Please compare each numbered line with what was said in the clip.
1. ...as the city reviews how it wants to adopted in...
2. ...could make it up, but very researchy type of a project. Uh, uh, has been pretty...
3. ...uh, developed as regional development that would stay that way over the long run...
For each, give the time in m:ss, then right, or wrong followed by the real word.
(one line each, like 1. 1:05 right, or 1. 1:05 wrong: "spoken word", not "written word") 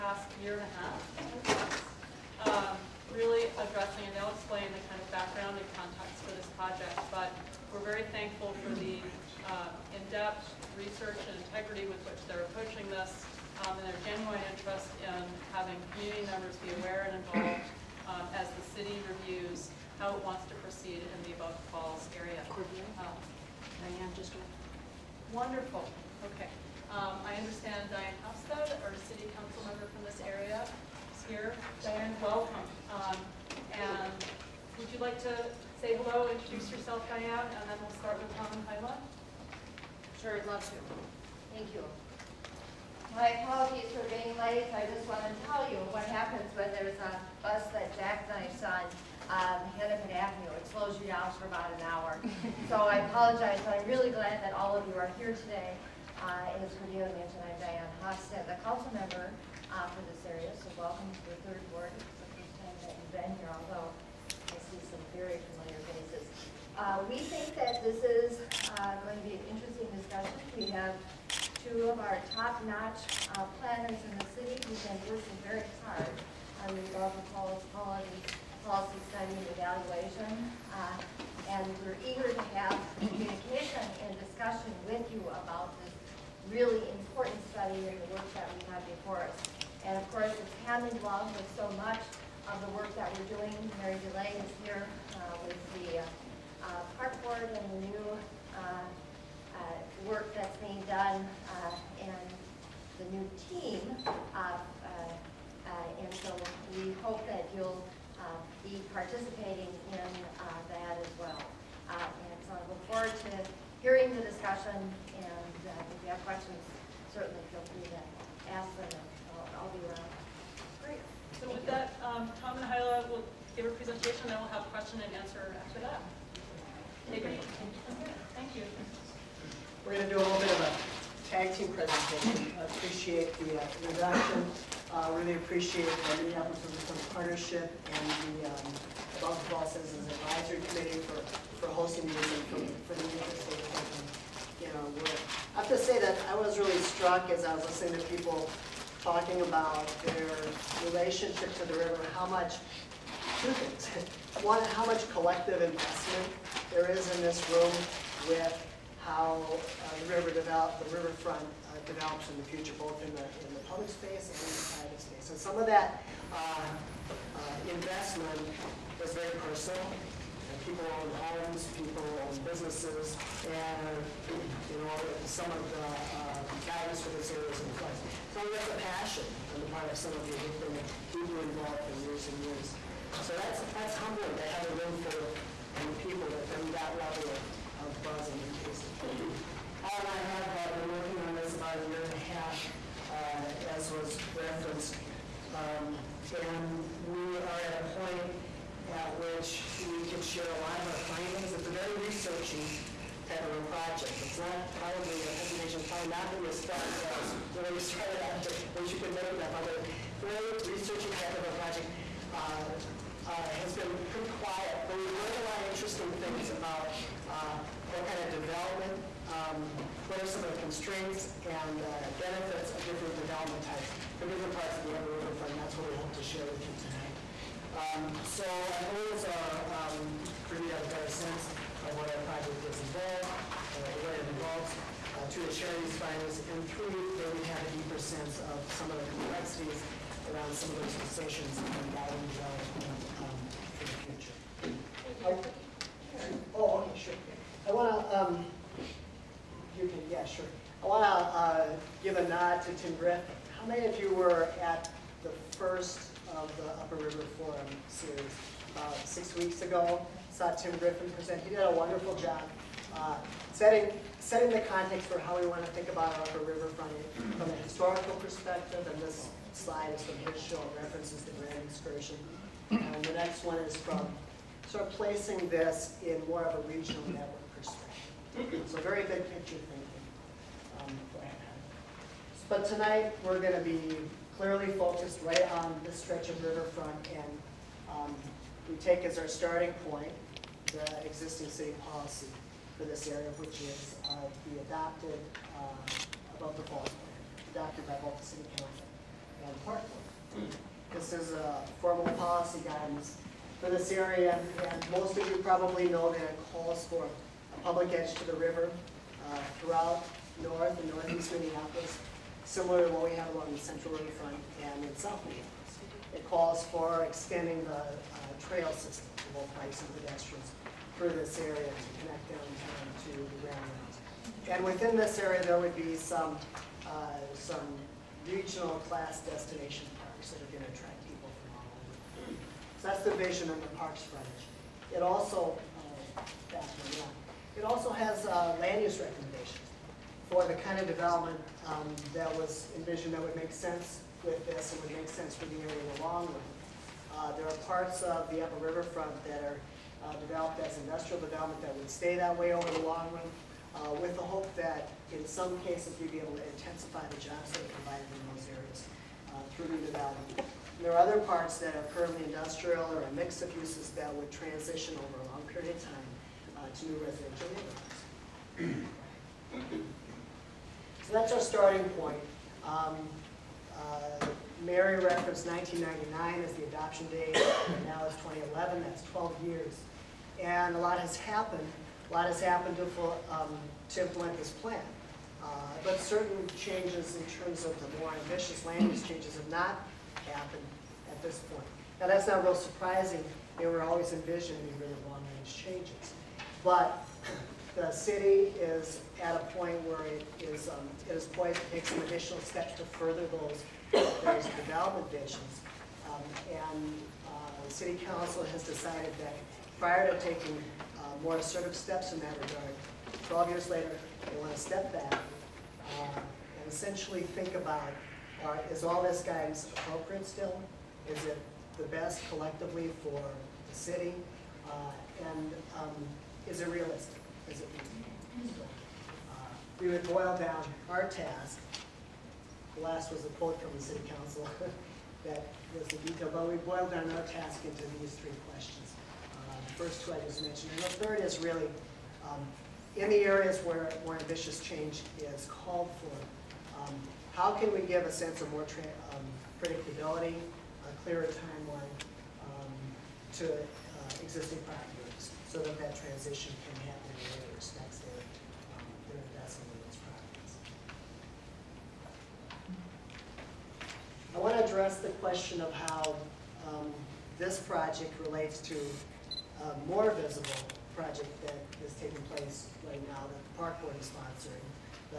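1. 0:18 wrong: "proceed", not "adopted"
2. 3:28 right
3. 5:50 wrong: "industrial", not "regional".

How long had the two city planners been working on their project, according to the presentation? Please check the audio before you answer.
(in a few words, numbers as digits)
About a year and a half.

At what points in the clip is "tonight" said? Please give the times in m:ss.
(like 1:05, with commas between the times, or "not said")
3:46, 4:42.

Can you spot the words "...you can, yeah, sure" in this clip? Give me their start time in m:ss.
4:09.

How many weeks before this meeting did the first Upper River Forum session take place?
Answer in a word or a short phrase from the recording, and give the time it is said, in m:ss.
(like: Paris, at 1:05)
6 weeks, at 4:19.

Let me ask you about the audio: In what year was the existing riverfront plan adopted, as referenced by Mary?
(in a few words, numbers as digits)
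1999.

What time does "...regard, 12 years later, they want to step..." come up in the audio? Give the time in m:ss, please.
6:52.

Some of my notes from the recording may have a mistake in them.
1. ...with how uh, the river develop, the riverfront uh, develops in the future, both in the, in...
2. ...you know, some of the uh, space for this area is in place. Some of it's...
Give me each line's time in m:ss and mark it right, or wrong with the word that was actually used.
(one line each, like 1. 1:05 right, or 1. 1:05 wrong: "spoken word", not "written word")
1. 2:38 right
2. 2:54 wrong: "guidance", not "space".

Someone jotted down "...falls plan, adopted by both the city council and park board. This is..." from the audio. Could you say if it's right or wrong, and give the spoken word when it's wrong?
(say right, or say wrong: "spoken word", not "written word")
right.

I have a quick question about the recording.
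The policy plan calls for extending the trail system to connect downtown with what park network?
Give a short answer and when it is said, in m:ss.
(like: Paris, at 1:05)
Grand Rounds, at 5:23.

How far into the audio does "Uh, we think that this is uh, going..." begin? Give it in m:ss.
1:06.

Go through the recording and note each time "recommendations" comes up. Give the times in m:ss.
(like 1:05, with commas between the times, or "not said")
5:39.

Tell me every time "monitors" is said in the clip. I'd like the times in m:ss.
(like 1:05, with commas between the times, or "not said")
not said.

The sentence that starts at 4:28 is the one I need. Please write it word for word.
And this slide is from his show references the Grand Excursion.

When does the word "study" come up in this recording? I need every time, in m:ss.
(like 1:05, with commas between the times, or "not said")
1:19, 1:27.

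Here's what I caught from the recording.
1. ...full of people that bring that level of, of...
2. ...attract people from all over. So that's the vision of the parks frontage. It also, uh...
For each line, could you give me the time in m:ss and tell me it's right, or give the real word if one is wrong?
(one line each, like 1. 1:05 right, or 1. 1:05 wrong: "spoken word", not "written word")
1. 3:05 right
2. 5:30 right.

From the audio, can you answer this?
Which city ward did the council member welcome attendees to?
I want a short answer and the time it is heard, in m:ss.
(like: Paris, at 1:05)
Third ward, at 1:01.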